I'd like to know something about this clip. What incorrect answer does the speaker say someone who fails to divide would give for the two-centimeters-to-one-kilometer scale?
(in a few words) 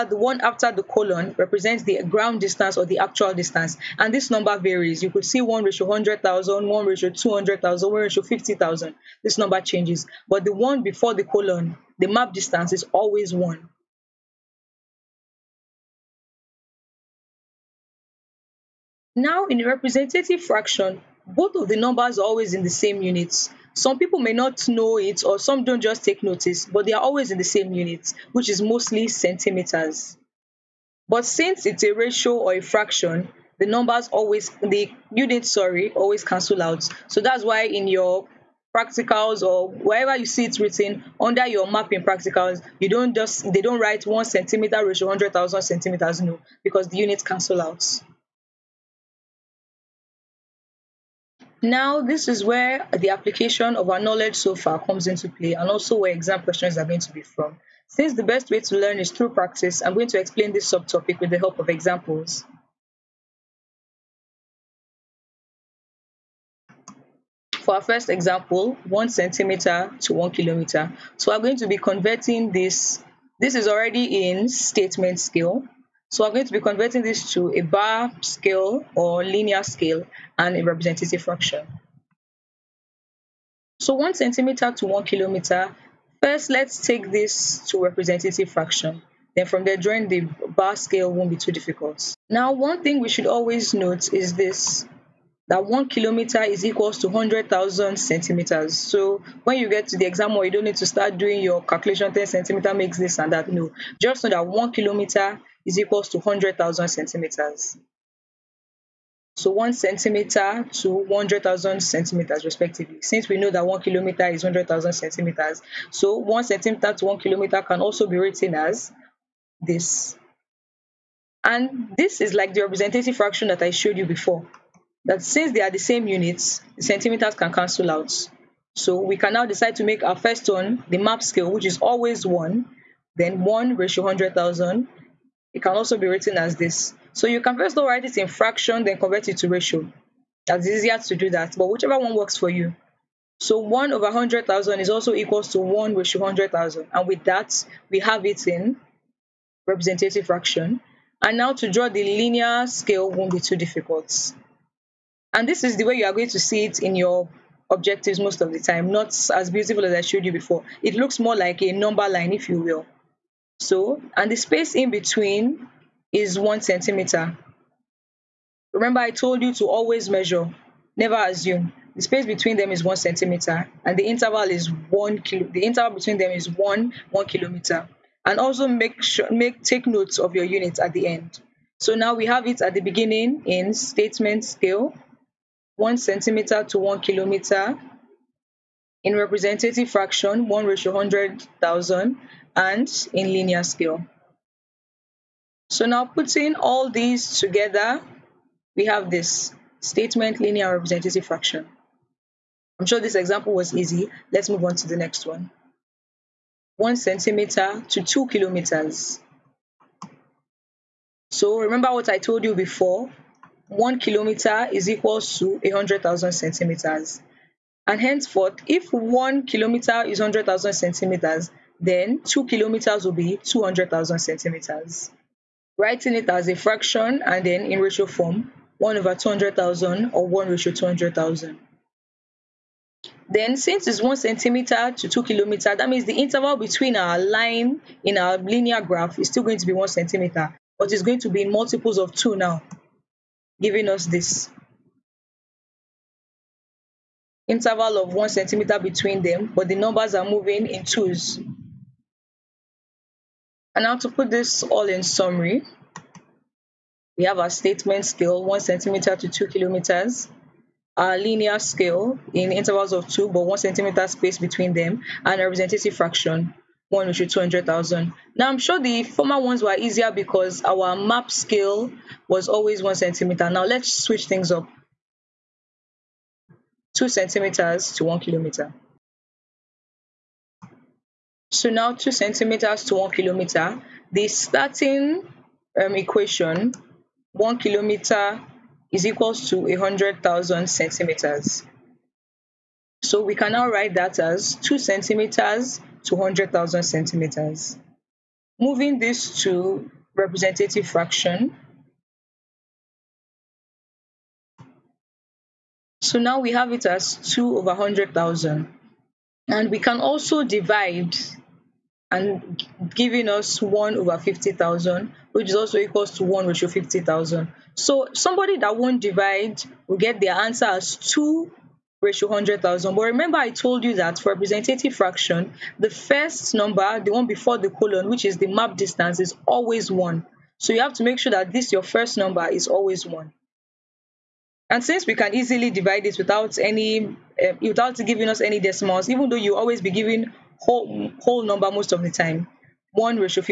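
2:100,000.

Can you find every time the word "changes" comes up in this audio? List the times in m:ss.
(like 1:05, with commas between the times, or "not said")
0:09.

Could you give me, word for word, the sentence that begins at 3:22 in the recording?
I'm sure this example was easy.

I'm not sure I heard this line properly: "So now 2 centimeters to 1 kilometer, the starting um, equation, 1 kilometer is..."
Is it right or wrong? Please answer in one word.
right.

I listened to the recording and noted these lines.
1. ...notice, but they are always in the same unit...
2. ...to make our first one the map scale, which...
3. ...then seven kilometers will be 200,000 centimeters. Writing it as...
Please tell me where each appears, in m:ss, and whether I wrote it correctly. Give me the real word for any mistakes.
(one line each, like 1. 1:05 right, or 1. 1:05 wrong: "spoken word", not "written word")
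1. 0:26 right
2. 2:09 right
3. 3:41 wrong: "two", not "seven".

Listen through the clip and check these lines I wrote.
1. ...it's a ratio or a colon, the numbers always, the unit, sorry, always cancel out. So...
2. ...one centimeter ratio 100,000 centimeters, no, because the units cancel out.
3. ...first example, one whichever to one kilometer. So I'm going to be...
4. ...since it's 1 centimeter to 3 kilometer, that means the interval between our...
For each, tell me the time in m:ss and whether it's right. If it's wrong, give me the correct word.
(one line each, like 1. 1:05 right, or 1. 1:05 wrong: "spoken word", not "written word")
1. 0:31 wrong: "fraction", not "colon"
2. 0:44 right
3. 1:07 wrong: "centimeter", not "whichever"
4. 3:53 wrong: "2", not "3".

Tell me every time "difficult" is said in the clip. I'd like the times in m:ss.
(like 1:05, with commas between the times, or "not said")
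1:31, 2:33.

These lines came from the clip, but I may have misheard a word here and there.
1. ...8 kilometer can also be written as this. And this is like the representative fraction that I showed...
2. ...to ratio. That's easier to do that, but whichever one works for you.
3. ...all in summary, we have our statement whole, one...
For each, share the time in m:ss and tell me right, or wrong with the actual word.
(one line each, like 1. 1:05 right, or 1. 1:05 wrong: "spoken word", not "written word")
1. 1:57 wrong: "1", not "8"
2. 2:19 right
3. 4:14 wrong: "scale", not "whole".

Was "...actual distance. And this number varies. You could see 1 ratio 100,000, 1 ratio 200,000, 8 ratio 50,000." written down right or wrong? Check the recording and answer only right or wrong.
wrong.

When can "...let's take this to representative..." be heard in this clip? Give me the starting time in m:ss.
1:26.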